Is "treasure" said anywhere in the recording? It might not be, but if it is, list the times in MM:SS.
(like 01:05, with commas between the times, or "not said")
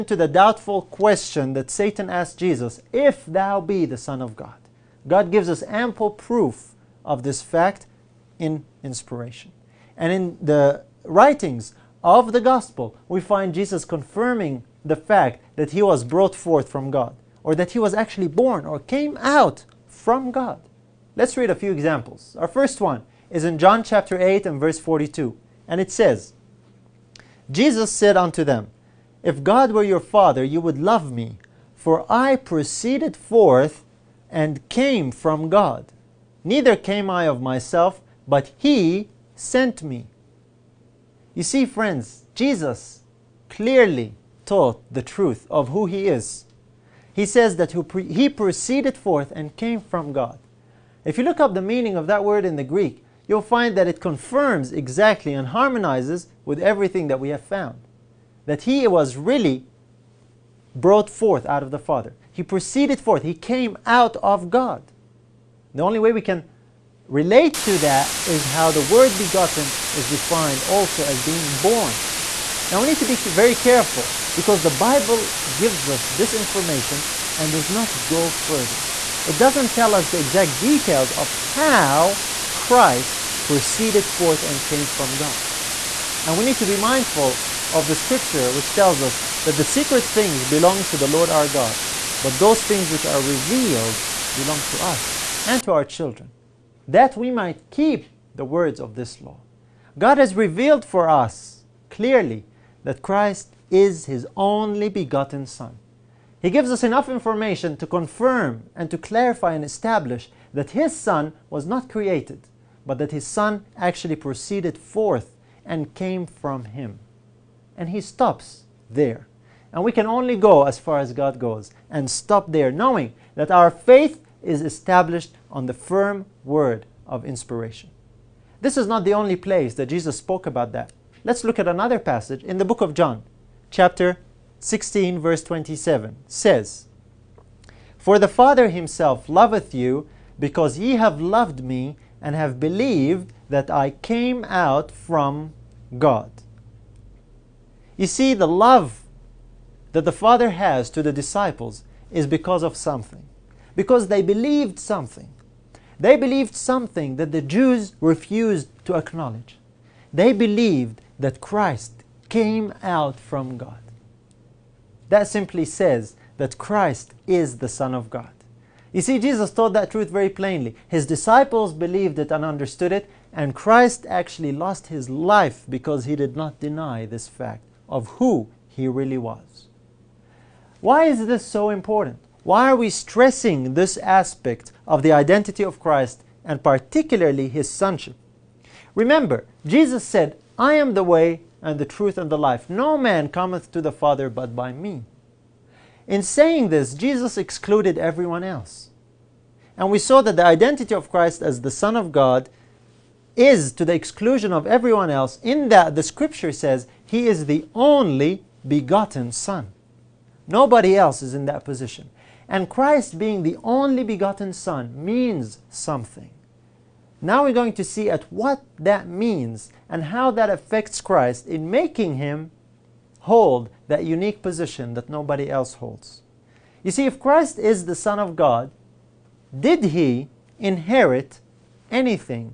not said.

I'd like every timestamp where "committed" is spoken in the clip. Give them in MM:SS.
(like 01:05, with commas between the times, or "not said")
not said.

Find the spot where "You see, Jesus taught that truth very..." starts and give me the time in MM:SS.
02:48.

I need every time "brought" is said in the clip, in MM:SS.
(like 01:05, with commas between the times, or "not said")
00:16, 01:00.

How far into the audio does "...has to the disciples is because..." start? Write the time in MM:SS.
02:30.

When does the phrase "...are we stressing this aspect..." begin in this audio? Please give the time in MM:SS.
03:02.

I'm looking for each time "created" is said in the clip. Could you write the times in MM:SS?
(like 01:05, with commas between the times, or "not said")
01:51.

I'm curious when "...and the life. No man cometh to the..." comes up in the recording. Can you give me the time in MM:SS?
03:12.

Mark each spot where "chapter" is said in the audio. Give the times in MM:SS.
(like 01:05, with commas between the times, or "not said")
00:23, 02:13.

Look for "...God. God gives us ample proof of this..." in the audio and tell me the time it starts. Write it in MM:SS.
00:04.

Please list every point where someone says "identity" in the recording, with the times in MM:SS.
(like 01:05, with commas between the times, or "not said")
03:05, 03:20.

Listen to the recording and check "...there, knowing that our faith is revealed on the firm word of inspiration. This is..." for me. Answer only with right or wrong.
wrong.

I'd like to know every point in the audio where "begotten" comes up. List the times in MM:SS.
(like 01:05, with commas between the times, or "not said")
01:09, 01:44, 03:28, 03:34.